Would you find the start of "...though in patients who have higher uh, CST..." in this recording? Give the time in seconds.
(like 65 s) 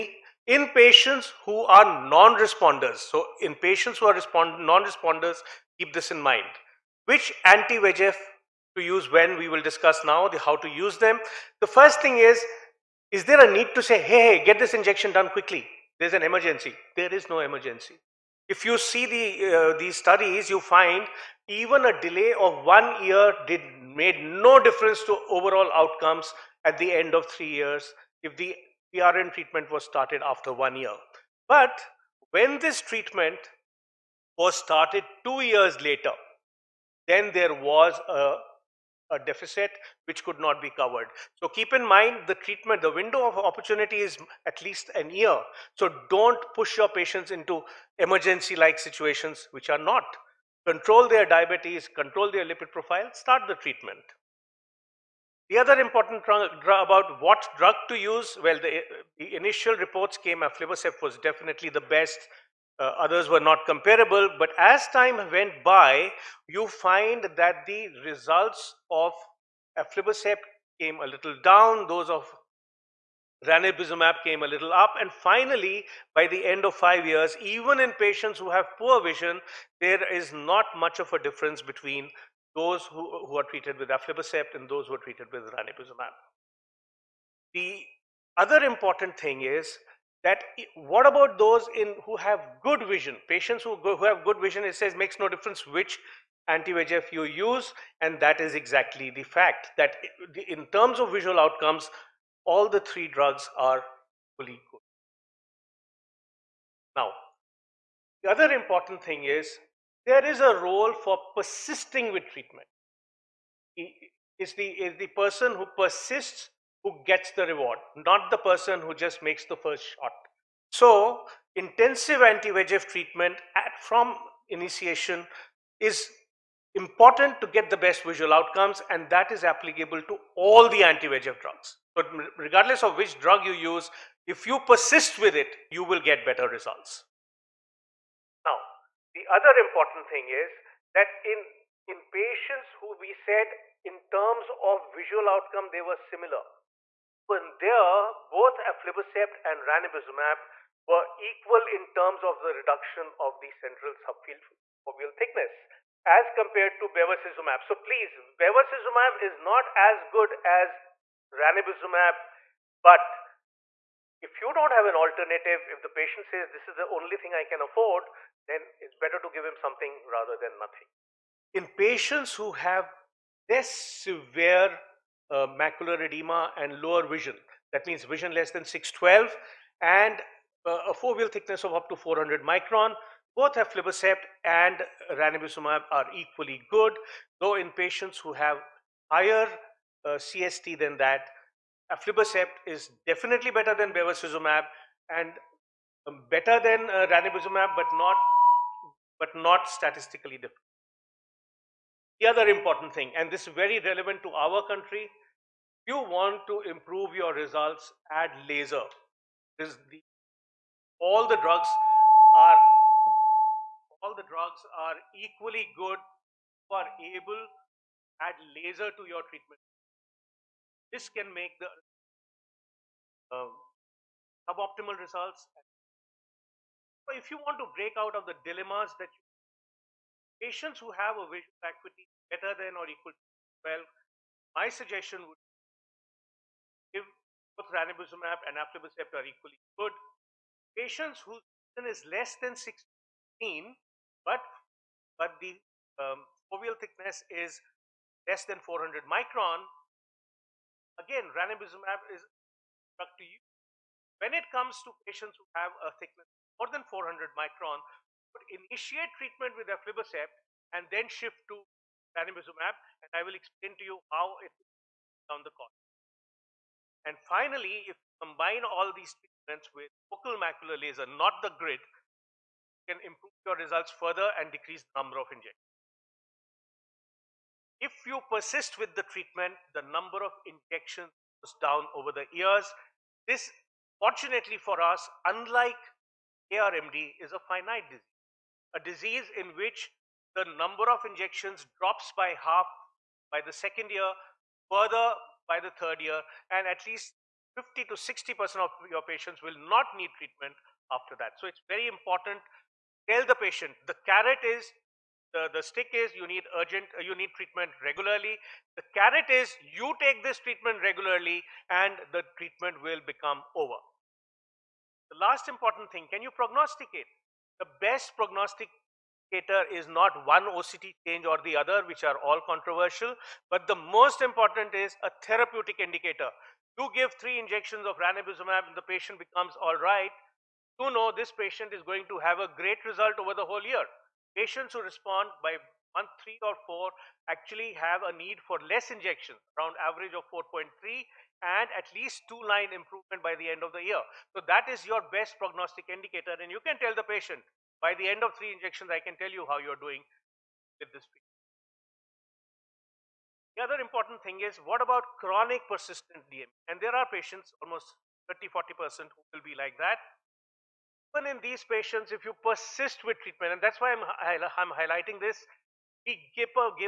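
187 s.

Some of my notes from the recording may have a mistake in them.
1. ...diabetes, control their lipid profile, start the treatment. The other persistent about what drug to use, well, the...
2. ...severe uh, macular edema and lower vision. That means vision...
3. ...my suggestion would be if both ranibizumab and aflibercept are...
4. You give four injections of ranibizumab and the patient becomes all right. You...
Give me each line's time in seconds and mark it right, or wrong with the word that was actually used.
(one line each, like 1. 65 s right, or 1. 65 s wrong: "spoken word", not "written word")
1. 51 s wrong: "important", not "persistent"
2. 173 s right
3. 234 s right
4. 326 s wrong: "three", not "four".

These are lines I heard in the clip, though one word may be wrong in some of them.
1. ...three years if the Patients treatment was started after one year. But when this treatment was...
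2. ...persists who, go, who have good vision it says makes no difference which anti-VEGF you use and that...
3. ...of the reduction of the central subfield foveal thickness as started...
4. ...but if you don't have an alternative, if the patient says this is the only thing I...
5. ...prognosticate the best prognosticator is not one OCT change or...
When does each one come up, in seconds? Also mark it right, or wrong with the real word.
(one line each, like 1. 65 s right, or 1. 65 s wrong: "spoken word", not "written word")
1. 27 s wrong: "PRN", not "Patients"
2. 93 s wrong: "patients", not "persists"
3. 152 s wrong: "compared", not "started"
4. 162 s right
5. 316 s right.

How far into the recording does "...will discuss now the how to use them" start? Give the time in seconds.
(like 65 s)
9 s.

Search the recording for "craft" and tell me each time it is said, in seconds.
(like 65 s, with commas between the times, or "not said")
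not said.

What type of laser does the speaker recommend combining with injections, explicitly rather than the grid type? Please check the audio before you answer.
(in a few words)
focal macular laser.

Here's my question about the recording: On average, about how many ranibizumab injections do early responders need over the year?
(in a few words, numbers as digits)
4.3.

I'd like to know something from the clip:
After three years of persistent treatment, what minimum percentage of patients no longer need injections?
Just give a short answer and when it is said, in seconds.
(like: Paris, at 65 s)
50 to 60%, at 297 s.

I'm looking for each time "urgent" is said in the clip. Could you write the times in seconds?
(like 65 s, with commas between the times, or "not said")
306 s.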